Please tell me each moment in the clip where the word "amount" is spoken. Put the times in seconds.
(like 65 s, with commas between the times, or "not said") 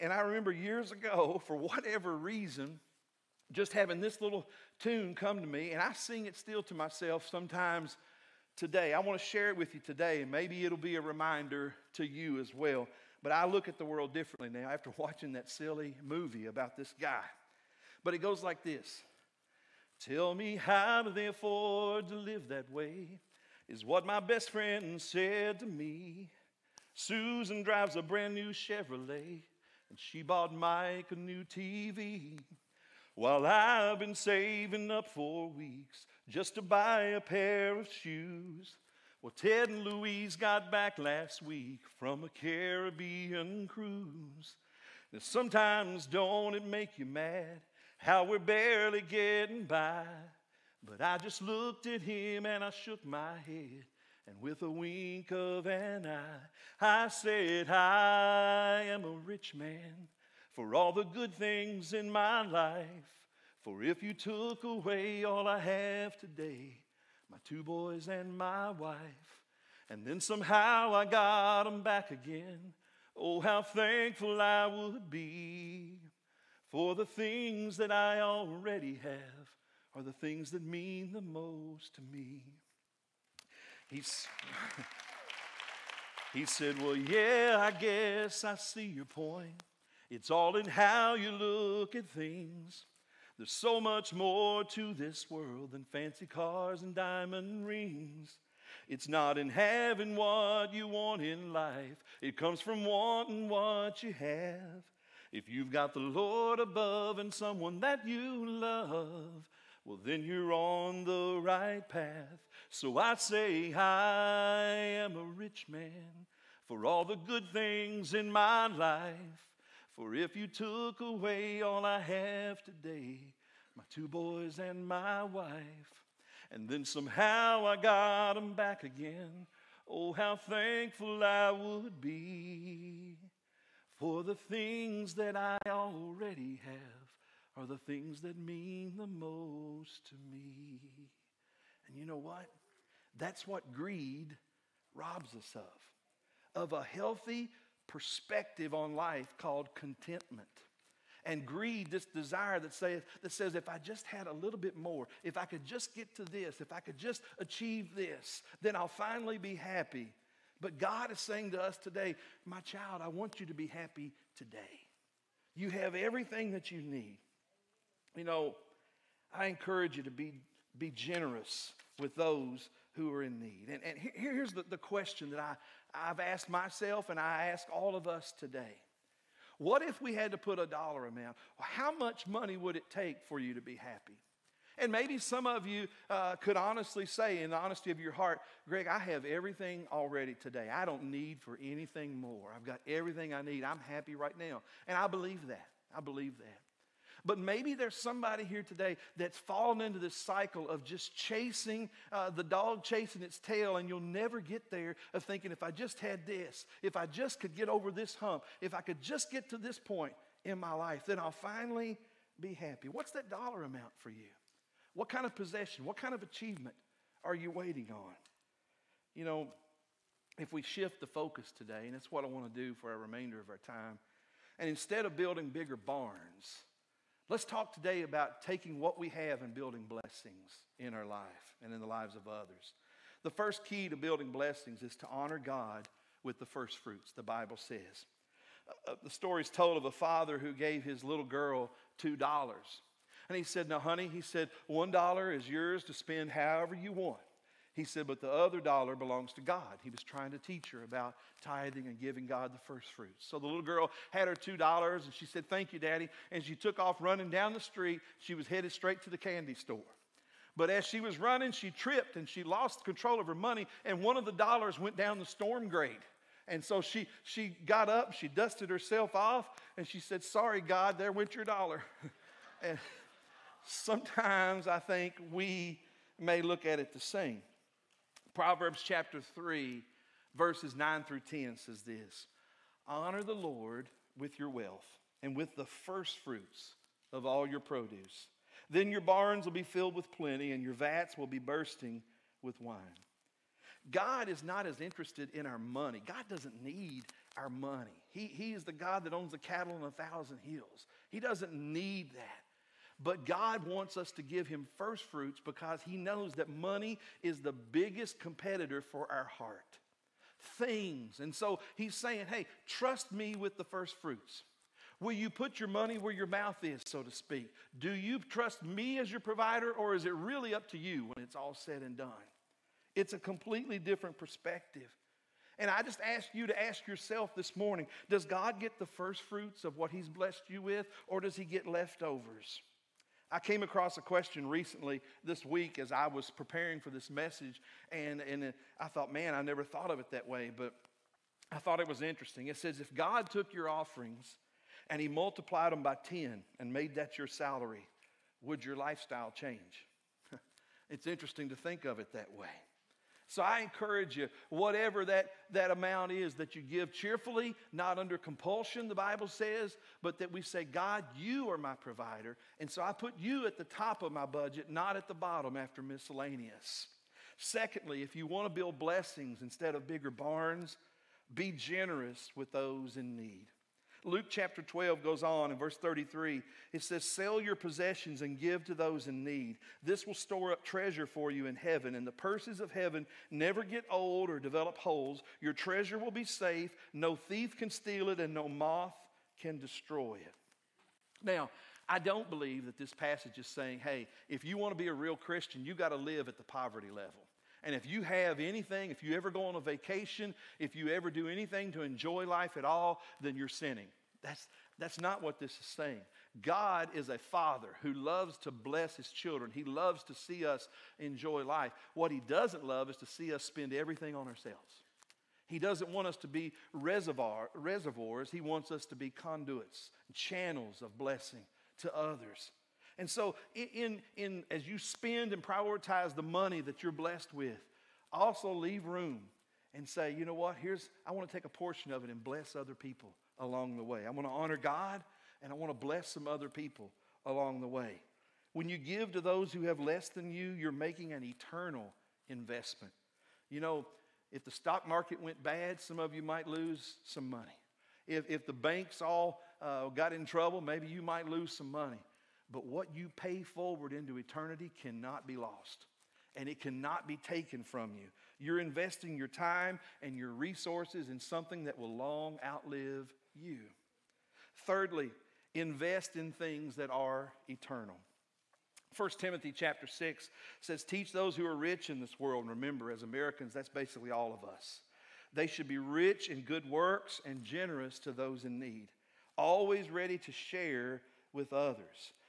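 181 s, 213 s, 355 s.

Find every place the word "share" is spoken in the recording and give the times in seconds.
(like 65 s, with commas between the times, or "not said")
9 s, 480 s.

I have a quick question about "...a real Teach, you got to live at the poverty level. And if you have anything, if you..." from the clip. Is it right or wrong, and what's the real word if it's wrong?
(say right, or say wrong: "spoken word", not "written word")
wrong: "Christian", not "Teach".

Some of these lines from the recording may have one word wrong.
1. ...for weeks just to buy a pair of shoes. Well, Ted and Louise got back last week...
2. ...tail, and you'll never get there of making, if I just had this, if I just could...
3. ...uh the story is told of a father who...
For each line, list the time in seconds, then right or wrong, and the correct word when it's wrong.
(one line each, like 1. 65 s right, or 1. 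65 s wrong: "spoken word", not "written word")
1. 35 s right
2. 203 s wrong: "thinking", not "making"
3. 238 s right.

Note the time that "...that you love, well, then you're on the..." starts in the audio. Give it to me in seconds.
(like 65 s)
107 s.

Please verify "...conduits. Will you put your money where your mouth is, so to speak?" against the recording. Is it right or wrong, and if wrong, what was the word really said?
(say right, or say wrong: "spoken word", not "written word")
wrong: "fruits", not "conduits".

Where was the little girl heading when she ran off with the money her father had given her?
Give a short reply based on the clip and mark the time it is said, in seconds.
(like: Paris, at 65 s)
the candy store, at 259 s.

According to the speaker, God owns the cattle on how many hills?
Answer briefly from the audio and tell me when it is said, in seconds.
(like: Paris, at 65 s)
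1,000, at 299 s.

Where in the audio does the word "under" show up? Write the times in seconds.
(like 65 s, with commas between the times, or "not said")
357 s.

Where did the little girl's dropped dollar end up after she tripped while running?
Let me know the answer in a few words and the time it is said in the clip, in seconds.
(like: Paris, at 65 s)
down the storm grate, at 264 s.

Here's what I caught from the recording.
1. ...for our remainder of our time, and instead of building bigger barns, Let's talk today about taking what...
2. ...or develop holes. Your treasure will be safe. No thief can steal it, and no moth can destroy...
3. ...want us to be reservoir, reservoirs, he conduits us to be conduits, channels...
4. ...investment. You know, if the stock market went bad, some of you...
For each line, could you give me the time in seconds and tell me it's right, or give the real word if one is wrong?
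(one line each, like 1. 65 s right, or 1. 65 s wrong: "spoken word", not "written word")
1. 222 s right
2. 384 s right
3. 415 s wrong: "wants", not "conduits"
4. 442 s right.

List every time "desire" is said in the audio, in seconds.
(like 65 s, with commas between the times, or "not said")
152 s.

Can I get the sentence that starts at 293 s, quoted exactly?
God is not as interested in our money.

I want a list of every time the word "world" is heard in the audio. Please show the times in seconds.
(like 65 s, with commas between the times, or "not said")
13 s, 95 s, 472 s.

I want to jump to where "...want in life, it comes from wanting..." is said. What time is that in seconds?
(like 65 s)
100 s.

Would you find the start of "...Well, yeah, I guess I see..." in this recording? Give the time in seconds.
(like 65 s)
86 s.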